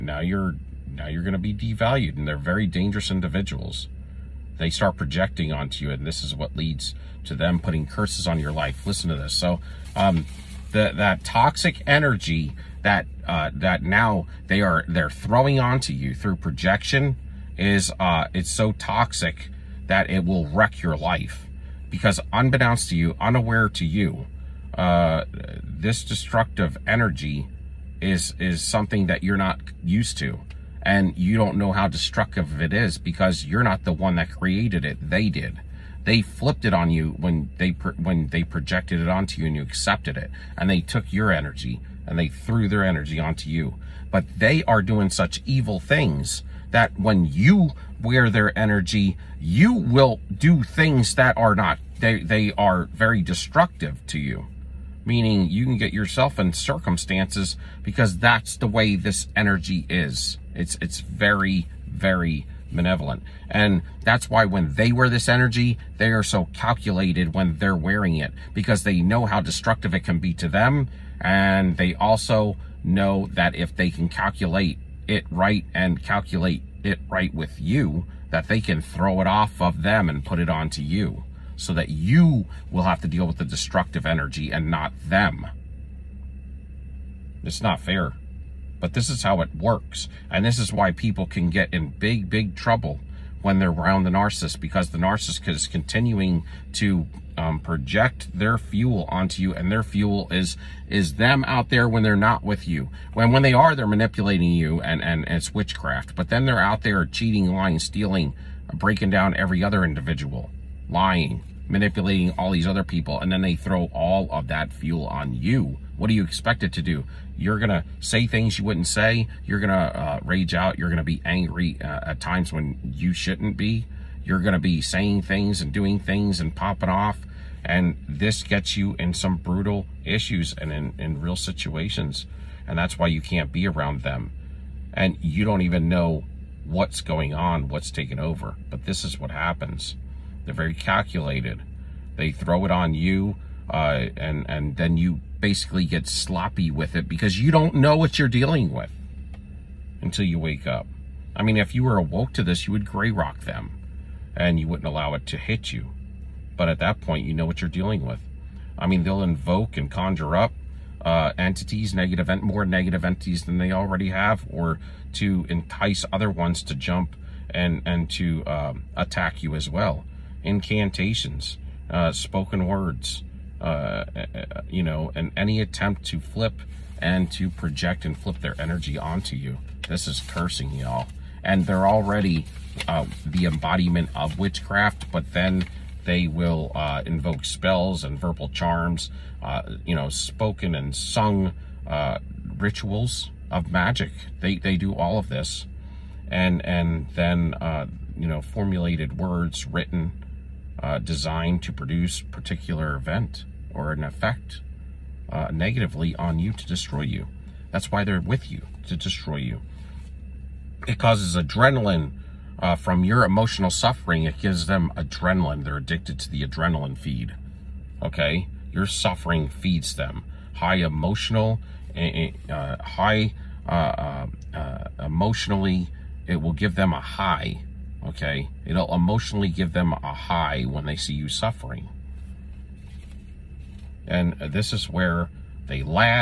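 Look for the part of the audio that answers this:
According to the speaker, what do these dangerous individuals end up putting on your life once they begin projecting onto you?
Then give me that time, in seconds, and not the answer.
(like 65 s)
7 s.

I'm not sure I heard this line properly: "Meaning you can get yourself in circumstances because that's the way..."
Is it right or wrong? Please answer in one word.
right.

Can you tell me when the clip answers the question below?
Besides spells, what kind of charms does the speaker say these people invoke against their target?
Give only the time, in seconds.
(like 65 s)
188 s.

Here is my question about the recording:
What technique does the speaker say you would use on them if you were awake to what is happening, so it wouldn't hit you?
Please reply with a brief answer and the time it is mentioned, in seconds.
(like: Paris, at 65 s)
gray rock, at 152 s.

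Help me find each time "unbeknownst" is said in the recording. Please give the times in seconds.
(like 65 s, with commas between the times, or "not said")
22 s.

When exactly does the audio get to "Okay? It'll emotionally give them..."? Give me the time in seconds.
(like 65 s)
228 s.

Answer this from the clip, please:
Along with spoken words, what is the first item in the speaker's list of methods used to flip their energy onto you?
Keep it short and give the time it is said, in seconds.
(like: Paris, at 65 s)
Incantations, at 170 s.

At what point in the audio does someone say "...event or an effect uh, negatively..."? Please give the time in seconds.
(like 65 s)
202 s.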